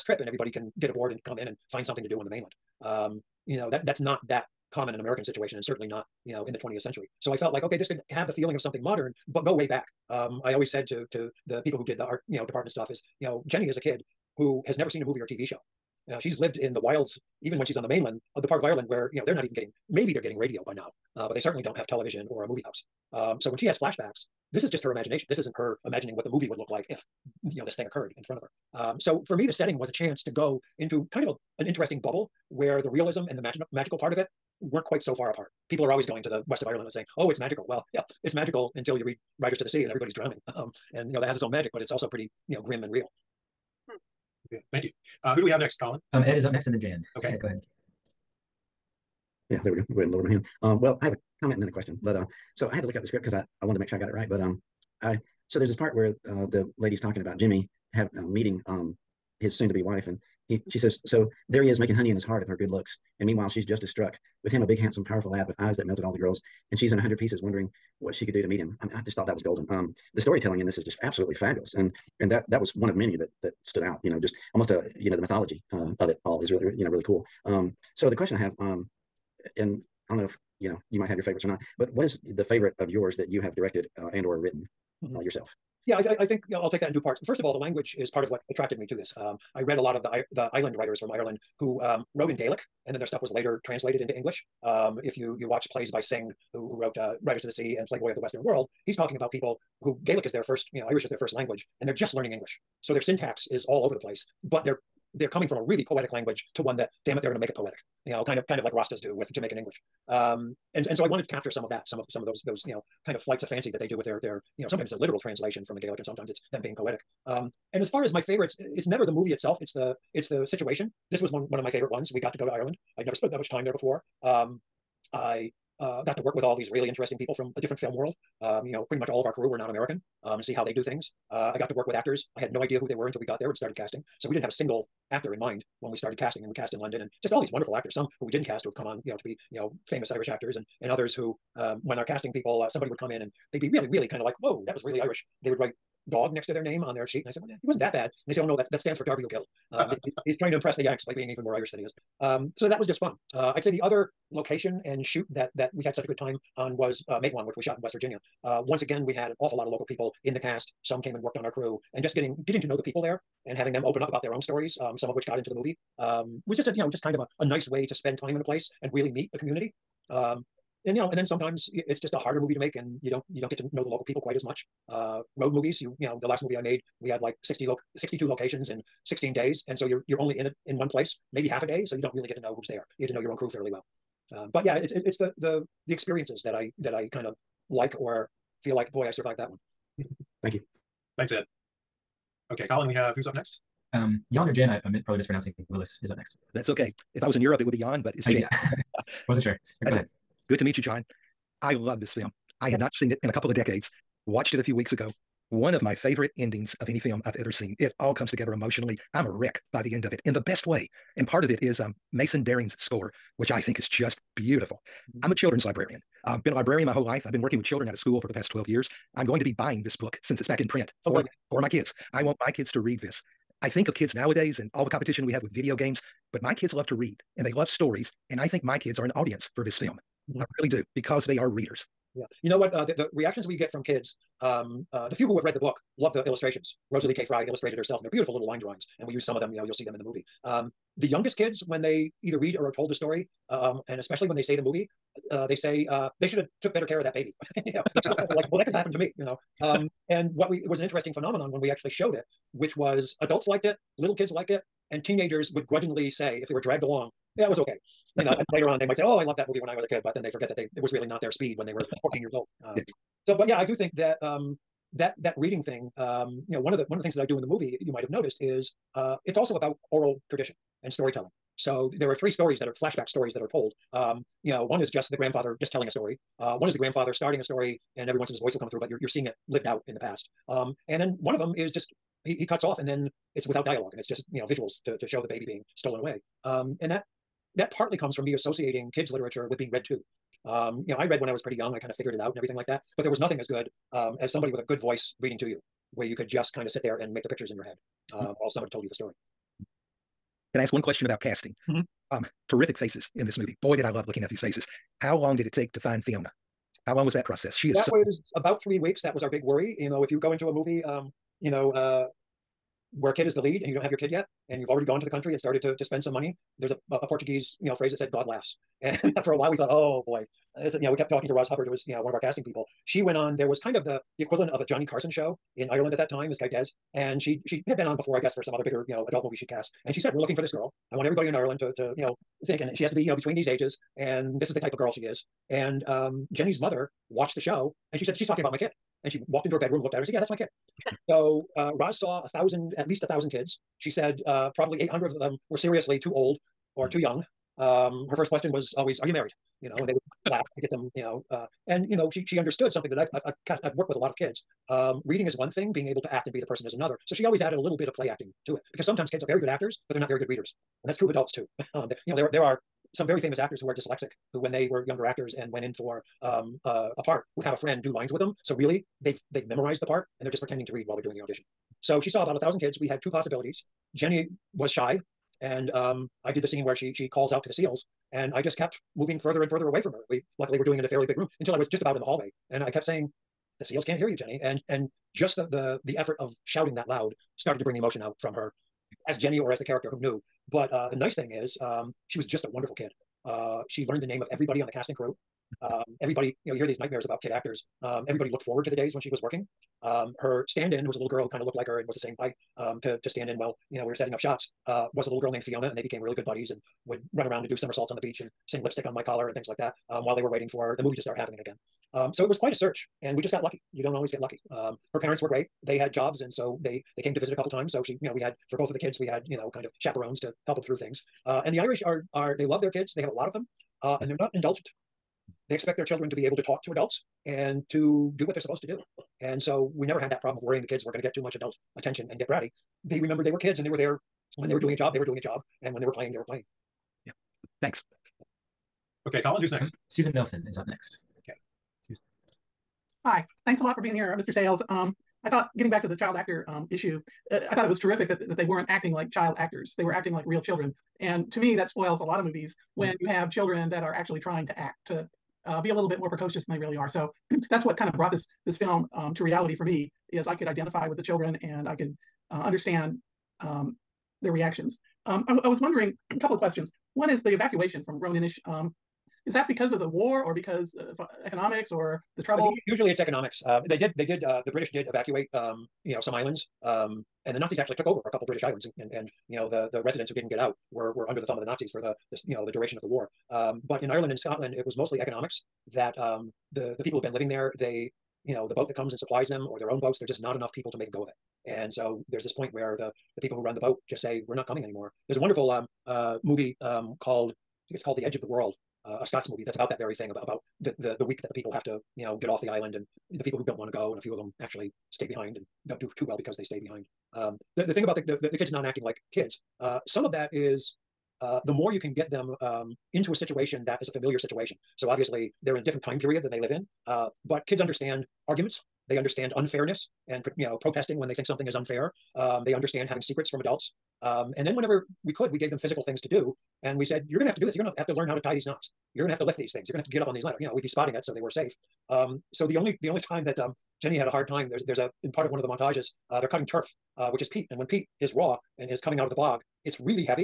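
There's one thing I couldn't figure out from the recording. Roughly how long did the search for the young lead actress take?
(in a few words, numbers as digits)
About three weeks.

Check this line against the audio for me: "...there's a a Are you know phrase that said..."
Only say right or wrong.
wrong.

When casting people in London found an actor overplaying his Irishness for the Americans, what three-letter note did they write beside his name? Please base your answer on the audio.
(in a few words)
dog.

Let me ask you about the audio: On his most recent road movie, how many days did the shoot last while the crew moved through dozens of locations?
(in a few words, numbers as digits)
16.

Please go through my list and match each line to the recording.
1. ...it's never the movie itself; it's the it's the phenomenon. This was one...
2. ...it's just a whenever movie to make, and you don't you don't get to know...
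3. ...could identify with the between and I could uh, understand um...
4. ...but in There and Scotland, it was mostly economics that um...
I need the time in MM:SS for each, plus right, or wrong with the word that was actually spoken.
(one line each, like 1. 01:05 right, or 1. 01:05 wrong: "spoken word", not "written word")
1. 01:58 wrong: "situation", not "phenomenon"
2. 02:51 wrong: "harder", not "whenever"
3. 07:40 wrong: "children", not "between"
4. 08:03 wrong: "Ireland", not "There".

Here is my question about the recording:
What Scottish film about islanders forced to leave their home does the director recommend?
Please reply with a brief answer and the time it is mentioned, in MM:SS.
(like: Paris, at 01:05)
The Edge of the World, at 08:17.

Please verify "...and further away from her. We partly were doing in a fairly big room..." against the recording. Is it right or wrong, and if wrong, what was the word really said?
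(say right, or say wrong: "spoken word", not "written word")
wrong: "luckily", not "partly".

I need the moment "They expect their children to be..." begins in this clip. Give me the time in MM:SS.
07:05.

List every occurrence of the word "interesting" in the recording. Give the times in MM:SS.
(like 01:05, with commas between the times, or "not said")
00:31, 02:06, 04:10.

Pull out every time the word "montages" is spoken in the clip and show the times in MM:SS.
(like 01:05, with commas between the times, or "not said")
08:55.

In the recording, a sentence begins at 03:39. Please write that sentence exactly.
I'm going to be buying this book since it's back in print oh, for, for my kids.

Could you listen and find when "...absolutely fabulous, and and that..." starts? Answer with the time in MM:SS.
01:11.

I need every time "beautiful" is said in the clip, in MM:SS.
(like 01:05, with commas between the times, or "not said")
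03:34, 03:58.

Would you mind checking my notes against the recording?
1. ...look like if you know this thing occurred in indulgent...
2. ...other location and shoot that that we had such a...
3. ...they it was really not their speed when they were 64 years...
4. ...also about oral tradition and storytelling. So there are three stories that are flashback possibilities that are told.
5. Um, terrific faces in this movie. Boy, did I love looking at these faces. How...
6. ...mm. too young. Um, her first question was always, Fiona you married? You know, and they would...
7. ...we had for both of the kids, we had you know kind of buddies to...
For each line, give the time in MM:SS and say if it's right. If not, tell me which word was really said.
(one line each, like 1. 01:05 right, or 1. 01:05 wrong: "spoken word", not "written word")
1. 00:26 wrong: "front", not "indulgent"
2. 02:33 right
3. 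04:20 wrong: "14", not "64"
4. 04:29 wrong: "stories", not "possibilities"
5. 05:02 right
6. 05:46 wrong: "Are", not "Fiona"
7. 06:58 wrong: "chaperones", not "buddies".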